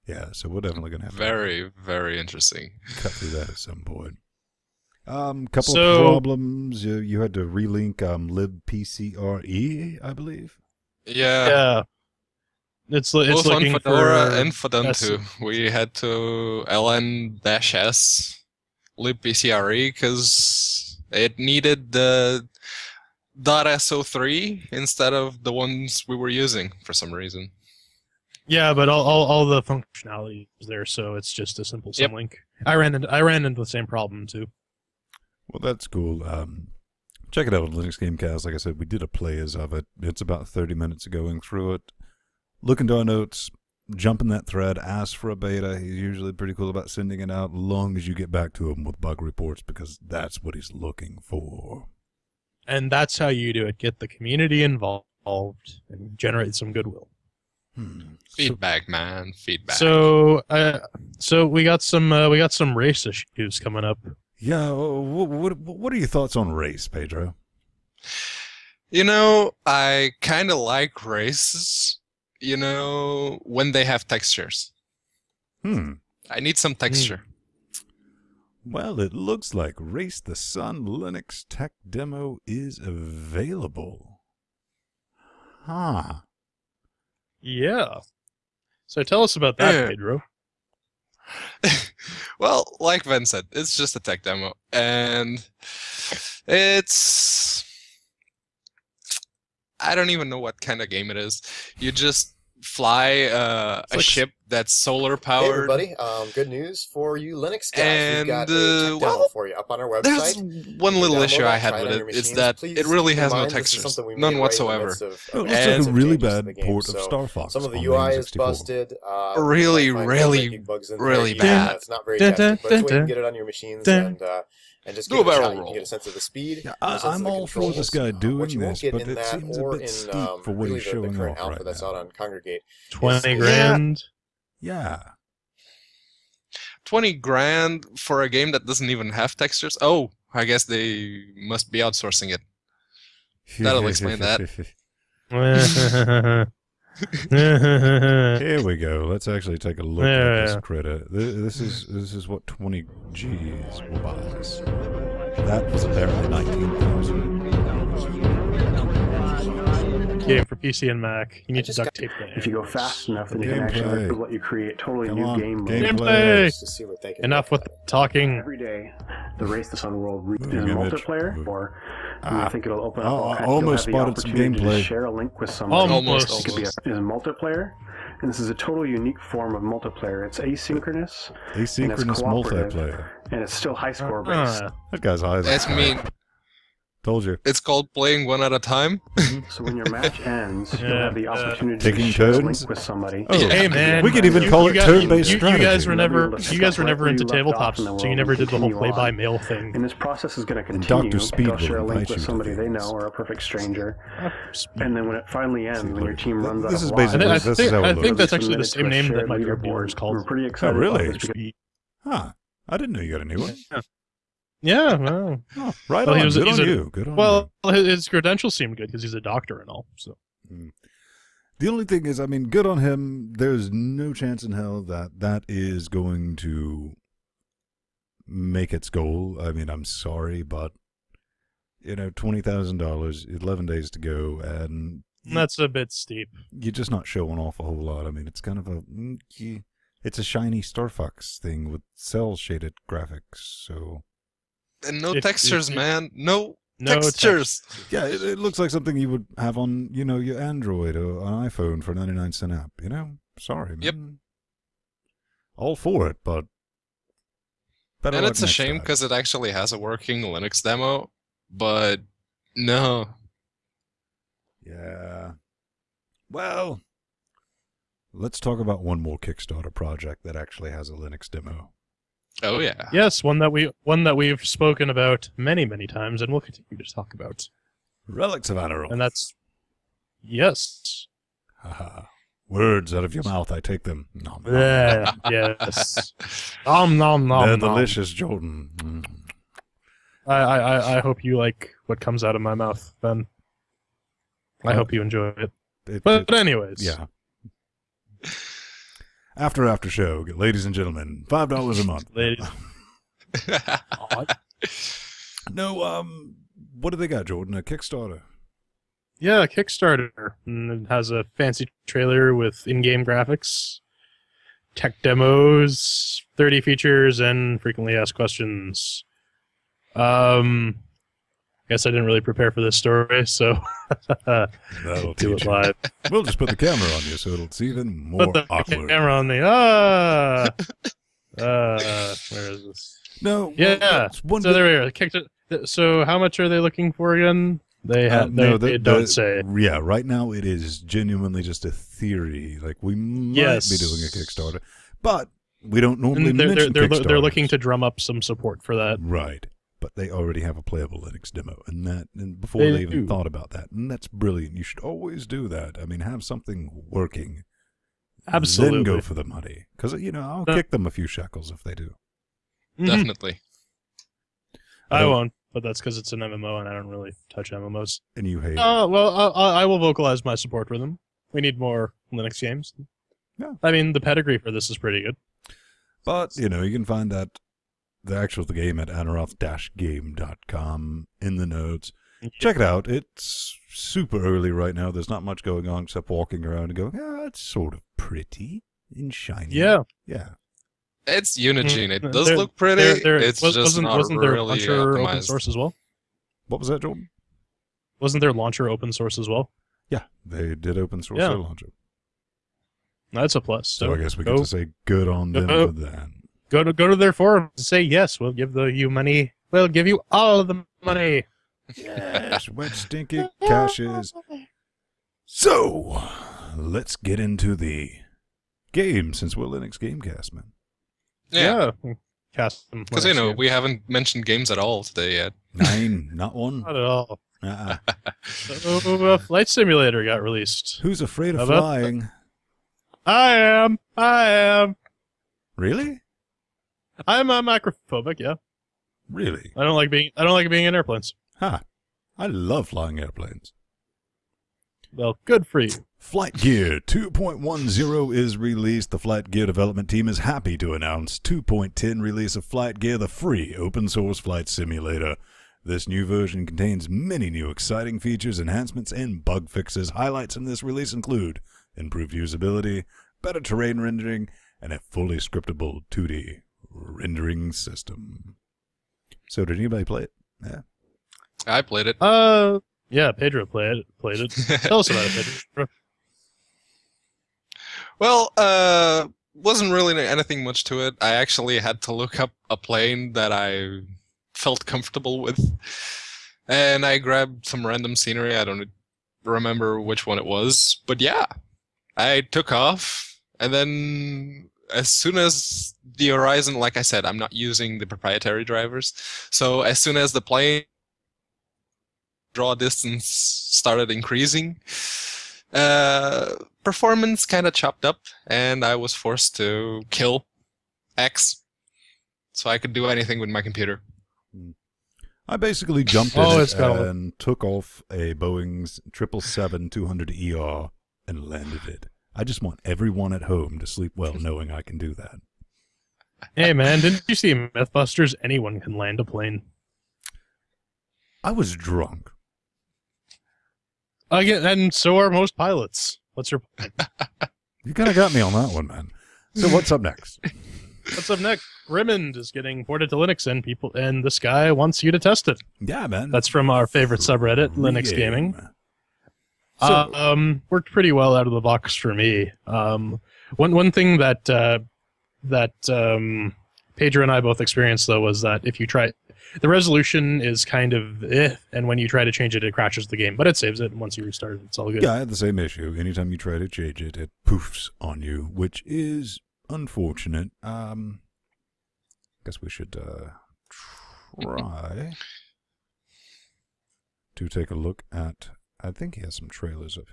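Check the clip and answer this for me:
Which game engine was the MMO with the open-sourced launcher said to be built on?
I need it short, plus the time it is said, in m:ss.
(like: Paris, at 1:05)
Unigine, at 6:31.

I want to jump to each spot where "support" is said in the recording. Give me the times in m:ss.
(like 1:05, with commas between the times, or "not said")
5:48, 6:10.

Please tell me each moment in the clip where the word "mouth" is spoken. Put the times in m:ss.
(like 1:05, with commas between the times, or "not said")
4:43, 4:52.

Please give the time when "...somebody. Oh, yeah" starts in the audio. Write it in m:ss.
3:12.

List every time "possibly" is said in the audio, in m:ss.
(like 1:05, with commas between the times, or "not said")
not said.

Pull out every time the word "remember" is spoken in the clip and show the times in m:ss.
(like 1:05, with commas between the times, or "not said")
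8:09.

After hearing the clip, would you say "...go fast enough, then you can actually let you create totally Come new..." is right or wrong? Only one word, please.
right.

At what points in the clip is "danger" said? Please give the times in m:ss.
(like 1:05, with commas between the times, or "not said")
not said.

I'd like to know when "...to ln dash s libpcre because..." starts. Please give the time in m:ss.
0:15.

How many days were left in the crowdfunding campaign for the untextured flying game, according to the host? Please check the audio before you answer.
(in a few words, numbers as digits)
11.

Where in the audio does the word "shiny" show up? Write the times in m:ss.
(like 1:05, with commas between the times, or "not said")
4:00, 6:29.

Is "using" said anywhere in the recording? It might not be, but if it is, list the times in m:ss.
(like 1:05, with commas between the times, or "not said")
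0:26, 8:17.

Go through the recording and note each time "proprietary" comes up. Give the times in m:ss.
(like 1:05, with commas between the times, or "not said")
8:17.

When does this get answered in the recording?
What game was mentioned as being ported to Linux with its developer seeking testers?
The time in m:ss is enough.
9:01.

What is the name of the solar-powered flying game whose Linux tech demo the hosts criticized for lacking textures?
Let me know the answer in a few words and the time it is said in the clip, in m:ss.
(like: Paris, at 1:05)
Race the Sun, at 1:19.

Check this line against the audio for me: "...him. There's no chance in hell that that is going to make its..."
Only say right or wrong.
right.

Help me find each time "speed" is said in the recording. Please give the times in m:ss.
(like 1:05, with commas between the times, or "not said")
2:06, 3:21.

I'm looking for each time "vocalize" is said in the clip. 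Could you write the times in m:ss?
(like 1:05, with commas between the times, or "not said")
6:09.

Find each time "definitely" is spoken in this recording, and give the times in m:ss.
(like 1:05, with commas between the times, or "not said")
0:00, 6:02.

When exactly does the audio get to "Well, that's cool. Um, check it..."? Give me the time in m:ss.
0:35.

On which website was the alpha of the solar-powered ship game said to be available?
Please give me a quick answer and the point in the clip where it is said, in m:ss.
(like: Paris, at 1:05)
Kongregate, at 2:12.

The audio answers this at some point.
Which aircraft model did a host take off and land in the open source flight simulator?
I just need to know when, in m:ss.
8:38.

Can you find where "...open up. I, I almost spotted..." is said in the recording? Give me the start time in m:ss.
2:52.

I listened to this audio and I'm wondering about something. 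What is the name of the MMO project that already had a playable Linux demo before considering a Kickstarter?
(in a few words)
Relics of Annorath.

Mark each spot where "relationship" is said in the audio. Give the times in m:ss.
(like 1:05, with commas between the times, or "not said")
not said.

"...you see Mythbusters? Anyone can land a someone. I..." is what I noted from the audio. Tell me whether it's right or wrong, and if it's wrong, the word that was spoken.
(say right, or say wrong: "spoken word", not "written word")
wrong: "plane", not "someone".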